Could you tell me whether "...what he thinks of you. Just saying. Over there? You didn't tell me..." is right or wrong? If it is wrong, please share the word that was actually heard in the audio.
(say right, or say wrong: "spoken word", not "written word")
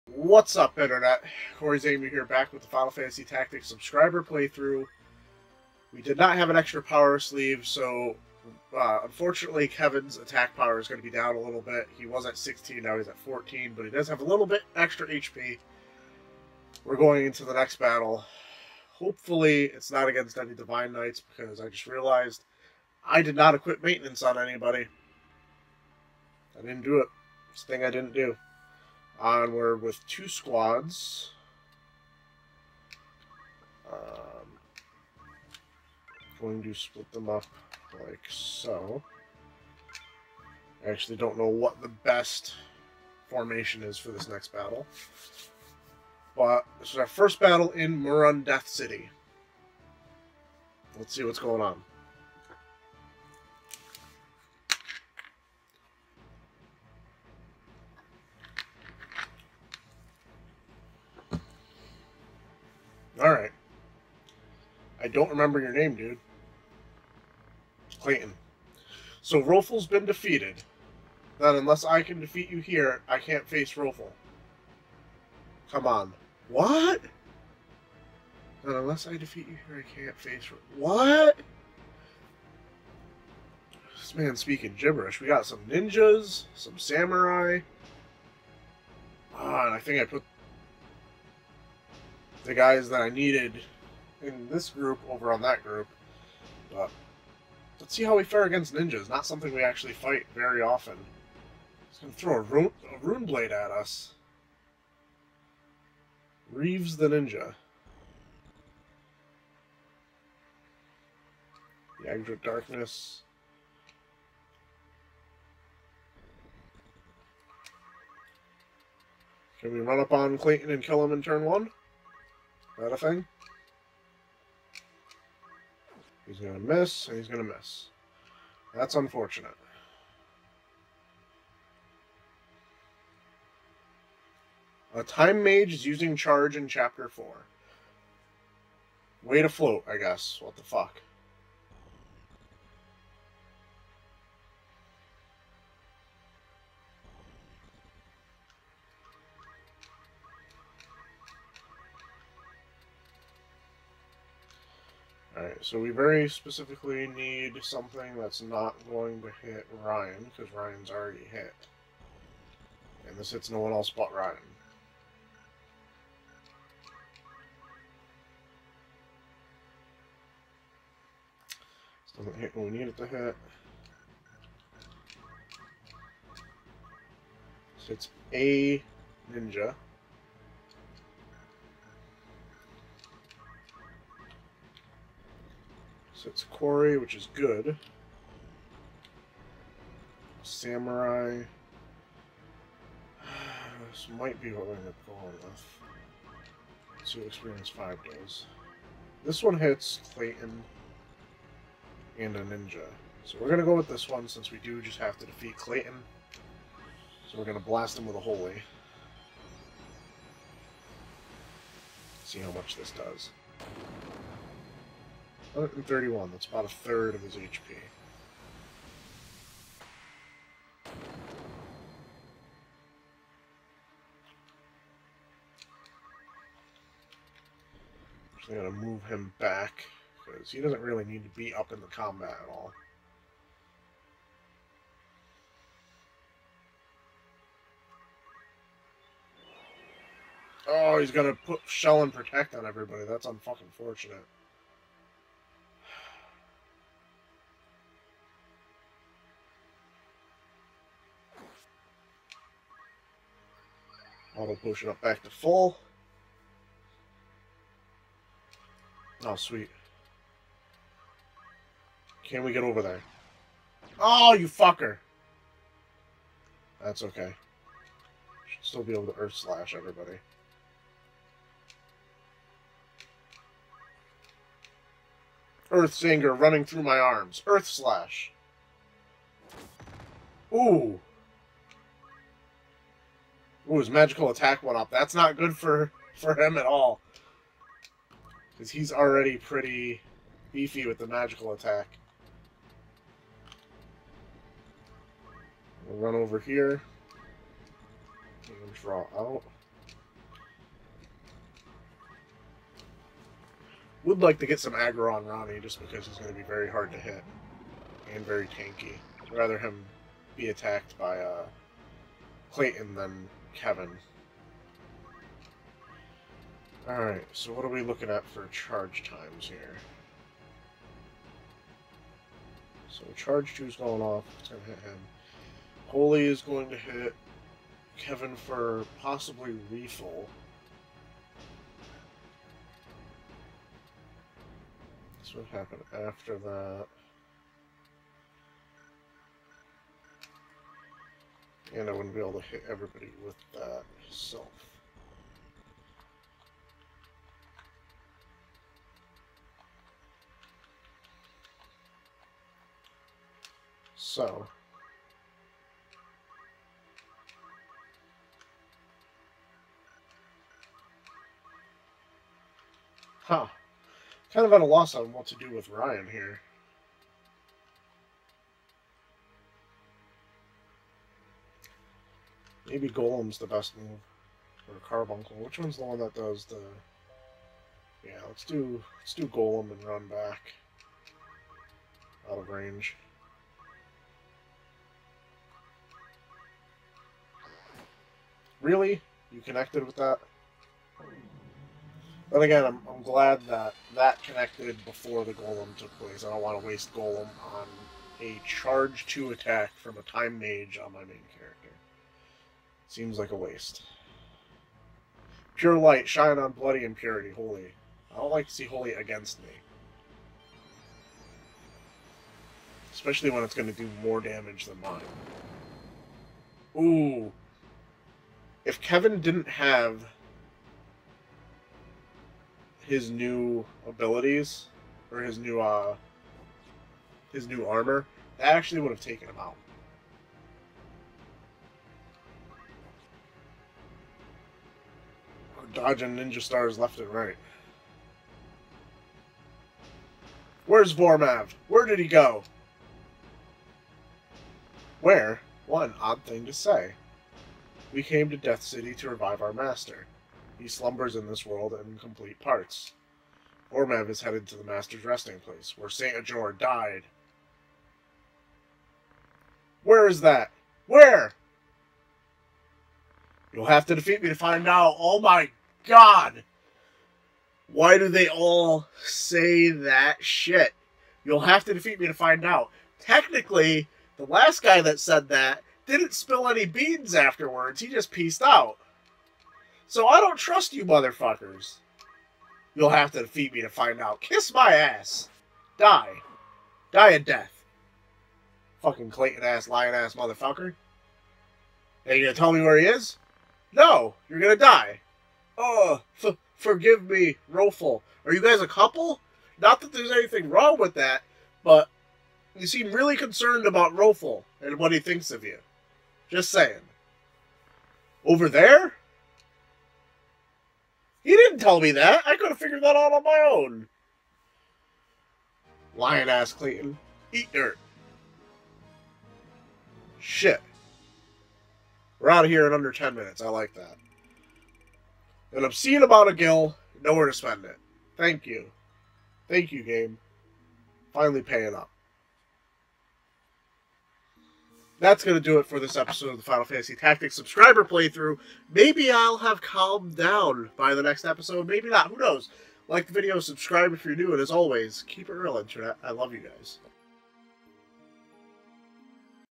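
right.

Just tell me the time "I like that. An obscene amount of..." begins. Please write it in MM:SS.
08:43.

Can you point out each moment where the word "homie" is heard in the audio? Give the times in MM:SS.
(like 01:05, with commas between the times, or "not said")
not said.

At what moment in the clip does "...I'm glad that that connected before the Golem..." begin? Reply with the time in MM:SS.
06:32.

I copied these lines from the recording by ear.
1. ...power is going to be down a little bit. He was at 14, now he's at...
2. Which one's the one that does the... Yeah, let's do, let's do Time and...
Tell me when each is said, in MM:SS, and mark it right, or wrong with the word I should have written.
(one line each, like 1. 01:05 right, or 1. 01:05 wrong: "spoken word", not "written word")
1. 00:10 wrong: "16", not "14"
2. 06:15 wrong: "Golem", not "Time".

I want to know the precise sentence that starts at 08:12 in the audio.
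Are you gonna tell me where he is?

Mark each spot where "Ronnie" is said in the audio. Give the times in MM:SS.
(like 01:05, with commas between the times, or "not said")
05:05.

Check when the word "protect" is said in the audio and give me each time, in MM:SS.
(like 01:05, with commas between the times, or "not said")
04:02.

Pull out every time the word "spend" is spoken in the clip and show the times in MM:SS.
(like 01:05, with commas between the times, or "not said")
08:47.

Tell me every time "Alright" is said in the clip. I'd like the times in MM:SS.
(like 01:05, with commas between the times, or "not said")
02:35, 05:16.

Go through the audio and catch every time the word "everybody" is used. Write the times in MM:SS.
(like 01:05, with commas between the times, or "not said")
04:02, 04:29, 05:42.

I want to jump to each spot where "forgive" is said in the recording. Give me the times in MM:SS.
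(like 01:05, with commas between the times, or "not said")
08:16.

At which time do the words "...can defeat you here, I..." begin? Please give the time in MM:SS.
01:12.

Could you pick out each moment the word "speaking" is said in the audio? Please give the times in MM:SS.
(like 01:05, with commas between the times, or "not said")
01:24.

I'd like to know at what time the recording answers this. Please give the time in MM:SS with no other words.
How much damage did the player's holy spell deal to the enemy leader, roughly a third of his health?
03:35.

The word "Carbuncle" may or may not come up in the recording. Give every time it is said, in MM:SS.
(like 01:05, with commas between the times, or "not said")
06:14.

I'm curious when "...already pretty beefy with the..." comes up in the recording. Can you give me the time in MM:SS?
04:48.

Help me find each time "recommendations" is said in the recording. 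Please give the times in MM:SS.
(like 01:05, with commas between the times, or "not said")
not said.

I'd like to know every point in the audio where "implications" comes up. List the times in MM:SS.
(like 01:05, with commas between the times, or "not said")
not said.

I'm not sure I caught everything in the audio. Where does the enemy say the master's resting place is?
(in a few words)
where St. Ajor died.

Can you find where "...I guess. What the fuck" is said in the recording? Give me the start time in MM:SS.
02:19.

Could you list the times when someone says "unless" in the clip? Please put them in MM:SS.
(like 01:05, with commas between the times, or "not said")
01:11, 01:18.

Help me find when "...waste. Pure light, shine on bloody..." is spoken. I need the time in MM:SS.
06:43.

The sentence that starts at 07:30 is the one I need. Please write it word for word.
He slumbers in this world in complete parts.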